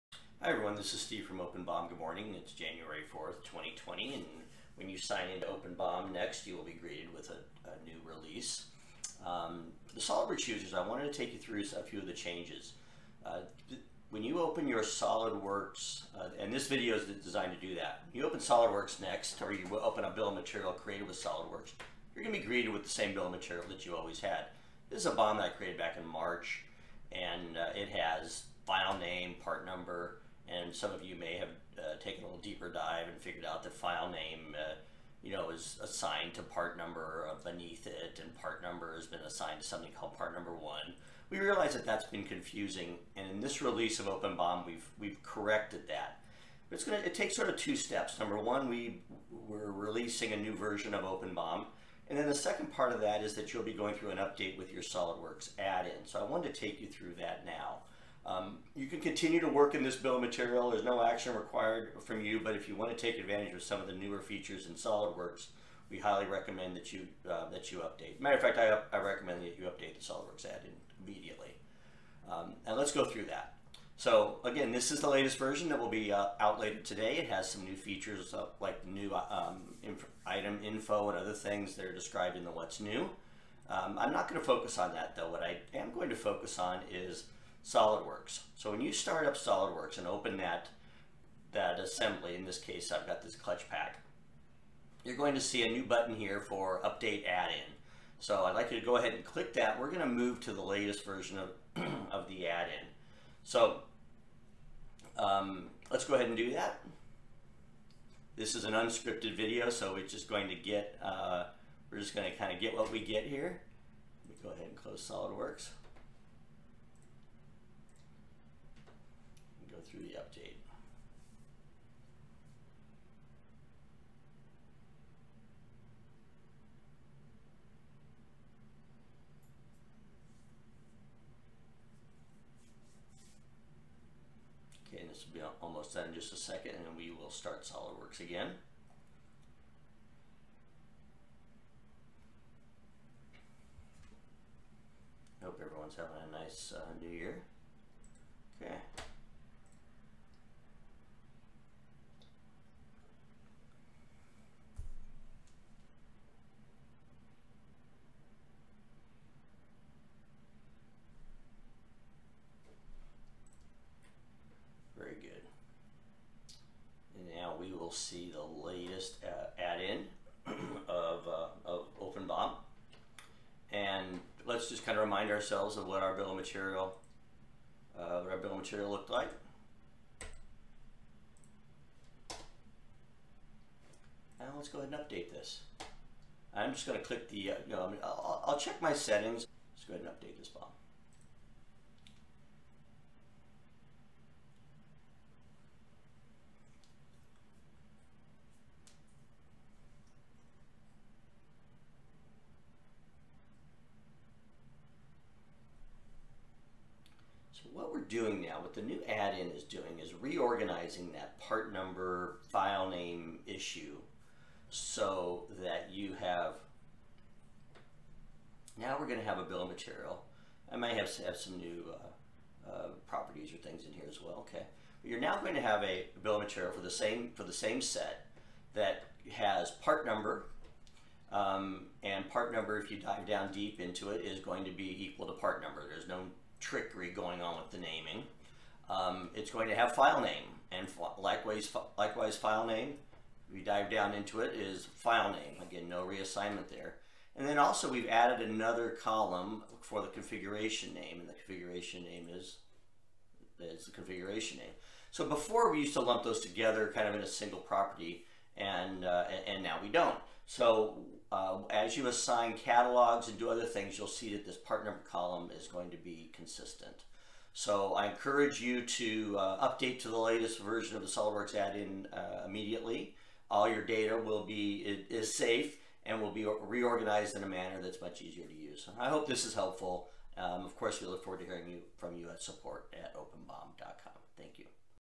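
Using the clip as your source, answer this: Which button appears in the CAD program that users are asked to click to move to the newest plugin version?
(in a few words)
Update Add-in.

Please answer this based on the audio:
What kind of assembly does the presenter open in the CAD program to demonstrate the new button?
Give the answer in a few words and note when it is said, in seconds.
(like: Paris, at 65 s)
Clutch pack, at 93 s.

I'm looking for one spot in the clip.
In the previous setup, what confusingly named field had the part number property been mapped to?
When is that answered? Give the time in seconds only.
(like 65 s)
40 s.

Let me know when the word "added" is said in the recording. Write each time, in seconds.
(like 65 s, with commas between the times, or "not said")
248 s.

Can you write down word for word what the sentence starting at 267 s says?
So I encourage you to uh, update to the latest version of the SOLIDWORKS add-in uh, immediately.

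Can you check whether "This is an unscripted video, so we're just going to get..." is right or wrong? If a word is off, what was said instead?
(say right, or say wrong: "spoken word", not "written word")
right.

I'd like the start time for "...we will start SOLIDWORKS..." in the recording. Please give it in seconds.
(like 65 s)
136 s.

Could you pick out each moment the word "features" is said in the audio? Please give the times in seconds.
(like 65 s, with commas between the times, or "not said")
64 s, 77 s.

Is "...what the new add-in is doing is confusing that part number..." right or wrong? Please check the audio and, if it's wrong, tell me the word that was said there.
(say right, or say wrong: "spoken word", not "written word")
wrong: "reorganizing", not "confusing".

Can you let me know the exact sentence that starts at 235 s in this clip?
There's no trickery going on with the naming.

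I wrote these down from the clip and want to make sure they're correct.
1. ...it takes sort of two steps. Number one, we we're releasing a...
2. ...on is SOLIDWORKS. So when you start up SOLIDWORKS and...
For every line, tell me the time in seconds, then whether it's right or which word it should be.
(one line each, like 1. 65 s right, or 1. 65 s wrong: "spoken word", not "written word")
1. 46 s right
2. 86 s right.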